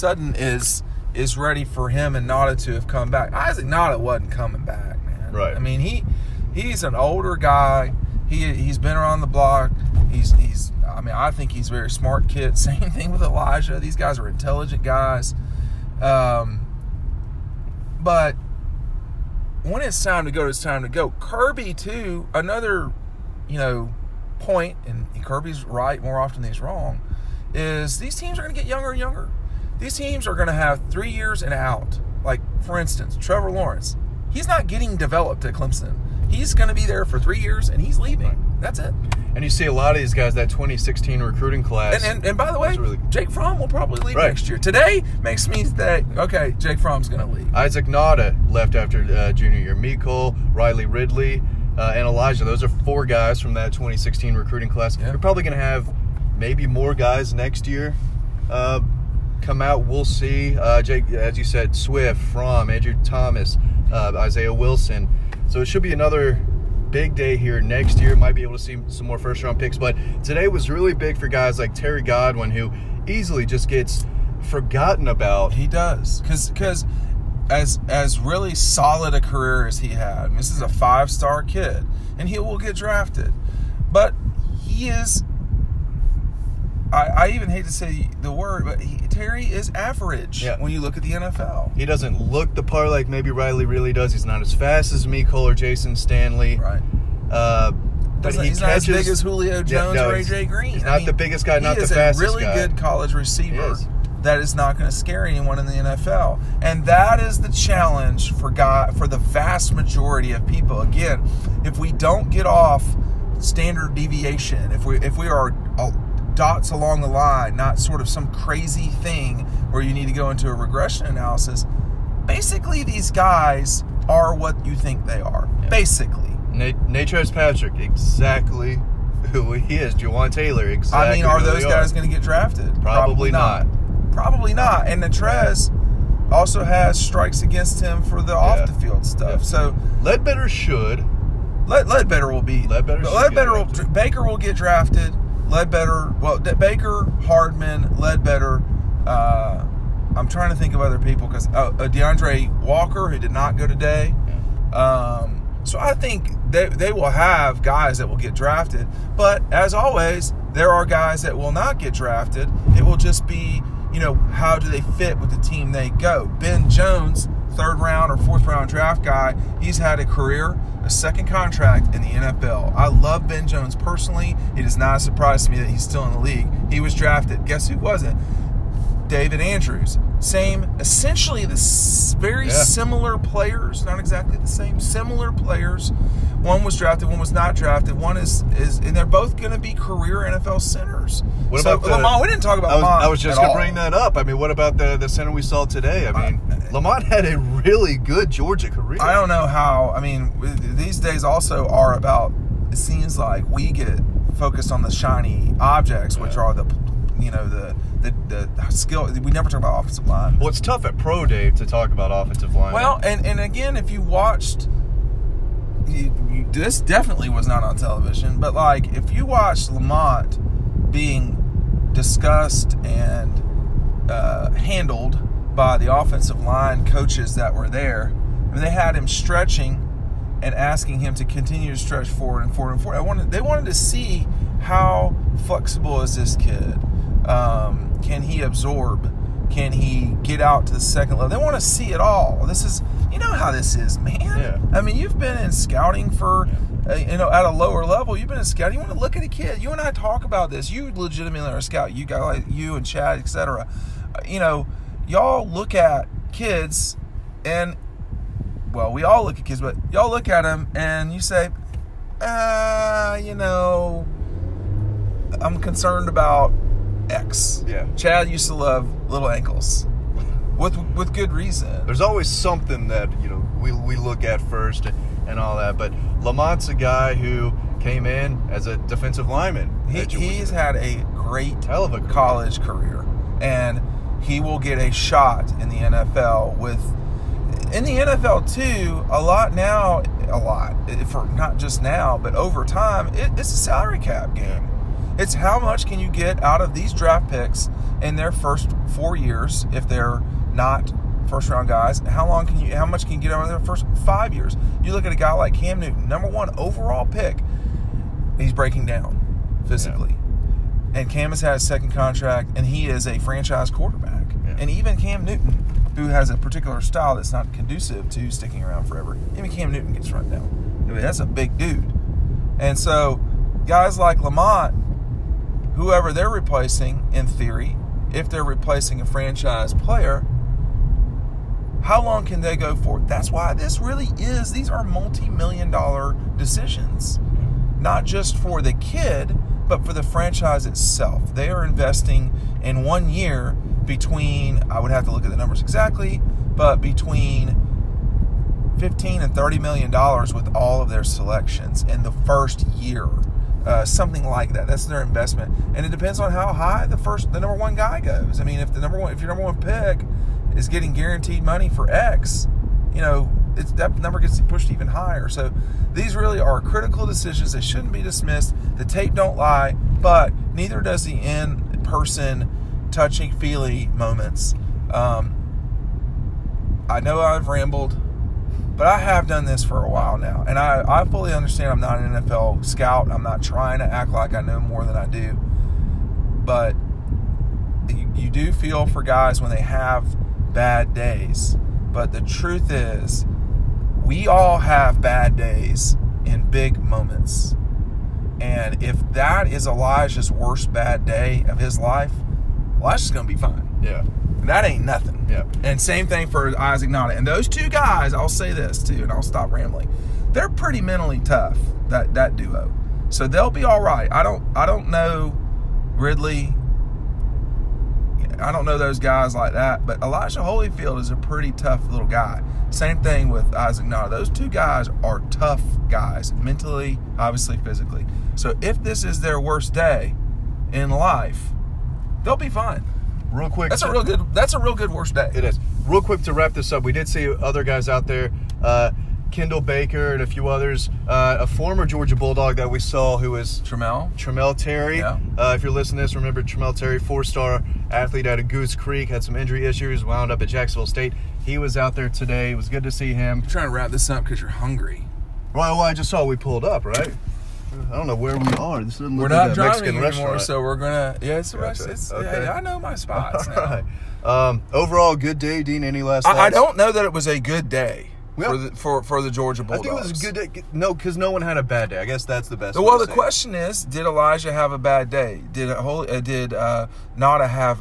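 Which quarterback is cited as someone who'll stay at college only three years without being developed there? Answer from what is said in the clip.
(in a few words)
Trevor Lawrence.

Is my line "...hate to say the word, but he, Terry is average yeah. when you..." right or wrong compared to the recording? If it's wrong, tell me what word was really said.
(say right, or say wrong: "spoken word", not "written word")
right.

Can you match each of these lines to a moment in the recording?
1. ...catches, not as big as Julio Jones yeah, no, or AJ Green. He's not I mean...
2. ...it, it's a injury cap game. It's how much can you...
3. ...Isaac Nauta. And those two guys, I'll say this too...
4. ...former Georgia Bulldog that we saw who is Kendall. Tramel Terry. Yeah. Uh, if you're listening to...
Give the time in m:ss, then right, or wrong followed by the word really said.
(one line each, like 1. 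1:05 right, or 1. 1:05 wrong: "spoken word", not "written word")
1. 1:38 right
2. 4:53 wrong: "salary", not "injury"
3. 6:46 right
4. 7:21 wrong: "Tramel", not "Kendall".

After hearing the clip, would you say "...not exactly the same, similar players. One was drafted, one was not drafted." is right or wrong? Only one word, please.
right.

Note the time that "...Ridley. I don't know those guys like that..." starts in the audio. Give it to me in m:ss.
6:55.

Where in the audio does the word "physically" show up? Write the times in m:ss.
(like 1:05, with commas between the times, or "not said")
5:09, 7:07.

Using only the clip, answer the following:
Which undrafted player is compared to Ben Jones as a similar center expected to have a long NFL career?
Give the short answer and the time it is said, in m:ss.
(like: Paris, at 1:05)
David Andrews, at 2:59.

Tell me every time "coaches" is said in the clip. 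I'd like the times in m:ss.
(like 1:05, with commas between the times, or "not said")
3:46.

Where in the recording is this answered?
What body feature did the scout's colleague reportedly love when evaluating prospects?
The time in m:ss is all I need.
4:29.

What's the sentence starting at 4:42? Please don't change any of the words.
college career, and he will get a shot in the NFL with in the NFL too.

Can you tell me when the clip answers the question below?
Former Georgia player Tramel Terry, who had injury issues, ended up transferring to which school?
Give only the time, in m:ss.
7:30.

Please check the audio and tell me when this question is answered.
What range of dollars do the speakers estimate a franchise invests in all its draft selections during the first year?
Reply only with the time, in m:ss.
5:48.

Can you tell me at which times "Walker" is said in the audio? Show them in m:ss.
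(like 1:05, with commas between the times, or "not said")
2:32.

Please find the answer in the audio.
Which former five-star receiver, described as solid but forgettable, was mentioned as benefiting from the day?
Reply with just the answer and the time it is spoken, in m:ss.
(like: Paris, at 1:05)
Terry Godwin, at 1:11.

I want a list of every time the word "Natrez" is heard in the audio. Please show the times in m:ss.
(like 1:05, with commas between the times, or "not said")
2:06, 2:15.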